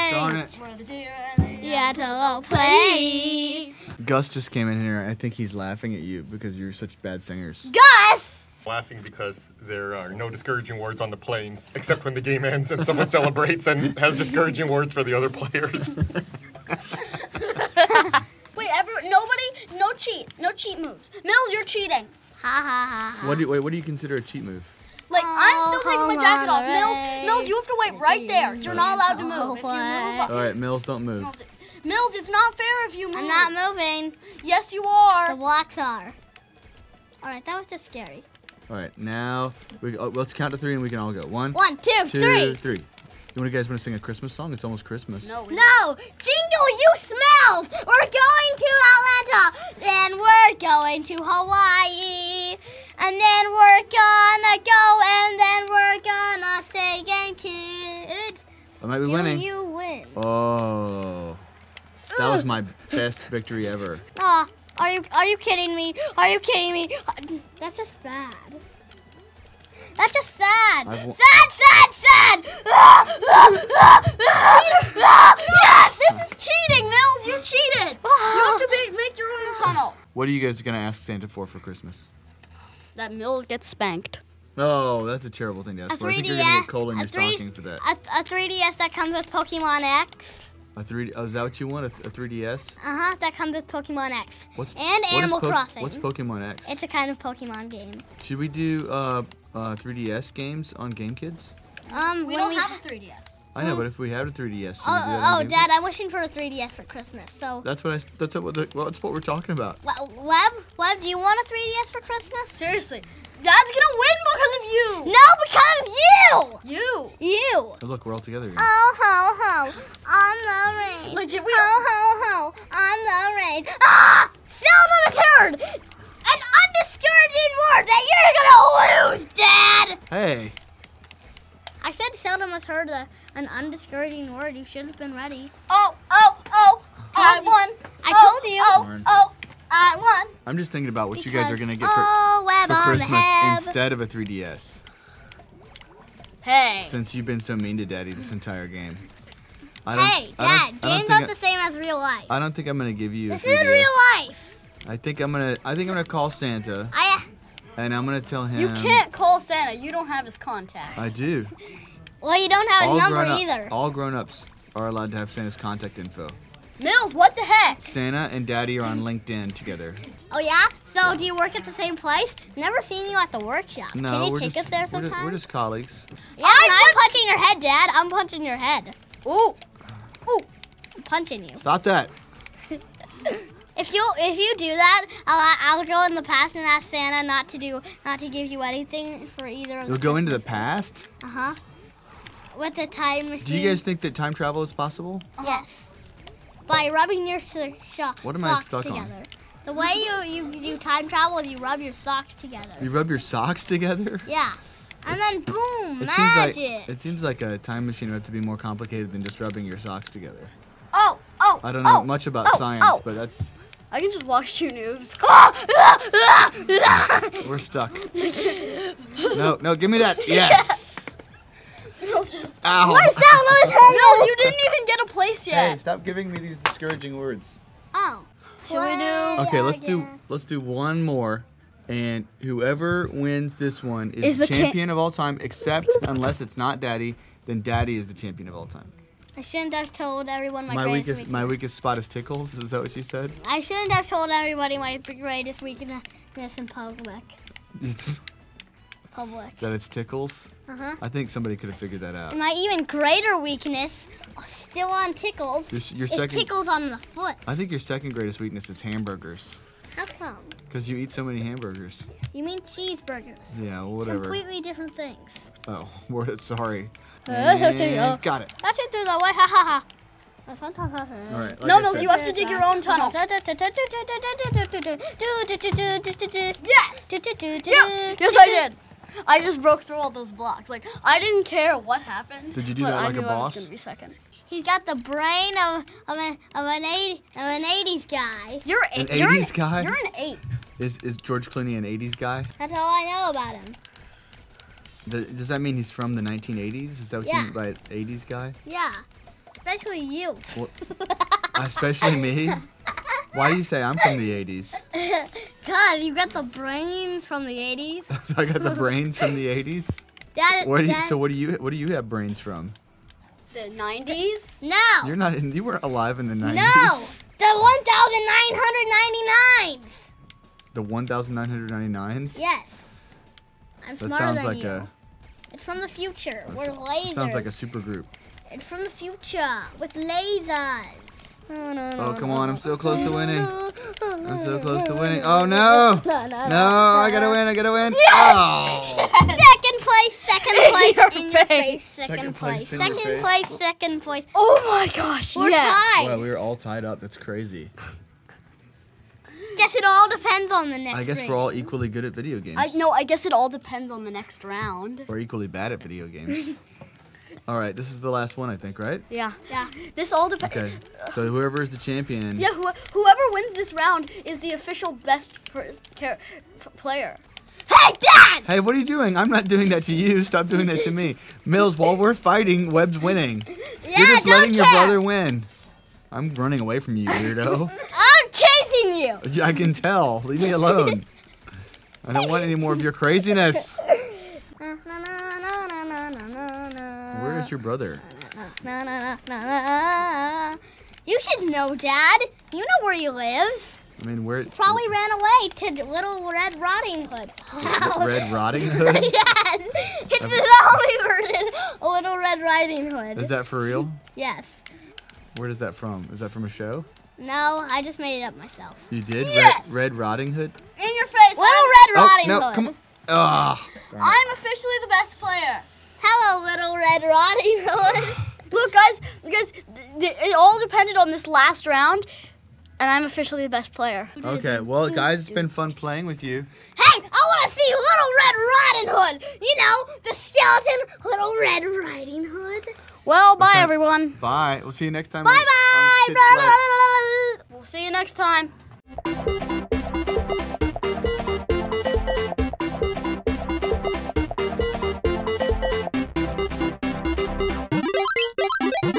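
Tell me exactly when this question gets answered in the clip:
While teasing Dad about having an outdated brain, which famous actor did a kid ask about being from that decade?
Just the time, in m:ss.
4:51.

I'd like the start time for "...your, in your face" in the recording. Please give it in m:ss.
5:41.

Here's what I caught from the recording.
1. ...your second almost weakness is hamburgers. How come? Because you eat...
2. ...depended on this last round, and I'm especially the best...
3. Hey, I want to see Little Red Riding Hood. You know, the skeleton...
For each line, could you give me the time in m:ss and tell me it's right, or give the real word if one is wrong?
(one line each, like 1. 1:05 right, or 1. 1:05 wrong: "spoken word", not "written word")
1. 4:17 wrong: "greatest", not "almost"
2. 7:00 wrong: "officially", not "especially"
3. 7:06 right.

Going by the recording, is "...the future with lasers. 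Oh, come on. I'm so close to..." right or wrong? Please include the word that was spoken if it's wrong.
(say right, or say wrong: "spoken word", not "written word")
right.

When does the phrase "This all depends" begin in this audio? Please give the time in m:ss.
5:59.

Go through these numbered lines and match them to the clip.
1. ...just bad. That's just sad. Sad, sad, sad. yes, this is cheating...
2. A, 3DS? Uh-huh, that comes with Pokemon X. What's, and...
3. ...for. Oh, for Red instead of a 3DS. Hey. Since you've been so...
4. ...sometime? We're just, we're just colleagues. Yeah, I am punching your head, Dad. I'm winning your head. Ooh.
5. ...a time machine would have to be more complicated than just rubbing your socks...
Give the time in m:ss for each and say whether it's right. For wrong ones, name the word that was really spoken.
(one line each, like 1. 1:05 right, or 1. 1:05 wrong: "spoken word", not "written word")
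1. 1:07 right
2. 1:31 right
3. 2:21 wrong: "Christmas", not "Red"
4. 2:54 wrong: "punching", not "winning"
5. 3:27 right.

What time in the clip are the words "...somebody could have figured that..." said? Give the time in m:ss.
4:11.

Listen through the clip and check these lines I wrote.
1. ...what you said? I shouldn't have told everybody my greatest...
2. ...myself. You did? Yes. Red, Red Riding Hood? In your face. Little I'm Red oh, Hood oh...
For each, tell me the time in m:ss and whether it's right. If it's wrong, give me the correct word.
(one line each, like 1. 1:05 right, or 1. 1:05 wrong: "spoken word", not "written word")
1. 4:02 right
2. 6:48 wrong: "Riding", not "Hood".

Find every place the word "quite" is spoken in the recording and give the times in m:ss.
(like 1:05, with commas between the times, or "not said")
not said.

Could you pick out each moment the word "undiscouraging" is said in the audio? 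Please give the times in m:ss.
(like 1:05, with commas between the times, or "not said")
2:06, 2:13.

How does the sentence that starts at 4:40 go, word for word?
Like I didn't care what happened.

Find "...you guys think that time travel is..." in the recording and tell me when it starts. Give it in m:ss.
3:13.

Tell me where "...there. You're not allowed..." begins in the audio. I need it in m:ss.
0:28.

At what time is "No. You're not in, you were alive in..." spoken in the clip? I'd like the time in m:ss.
5:14.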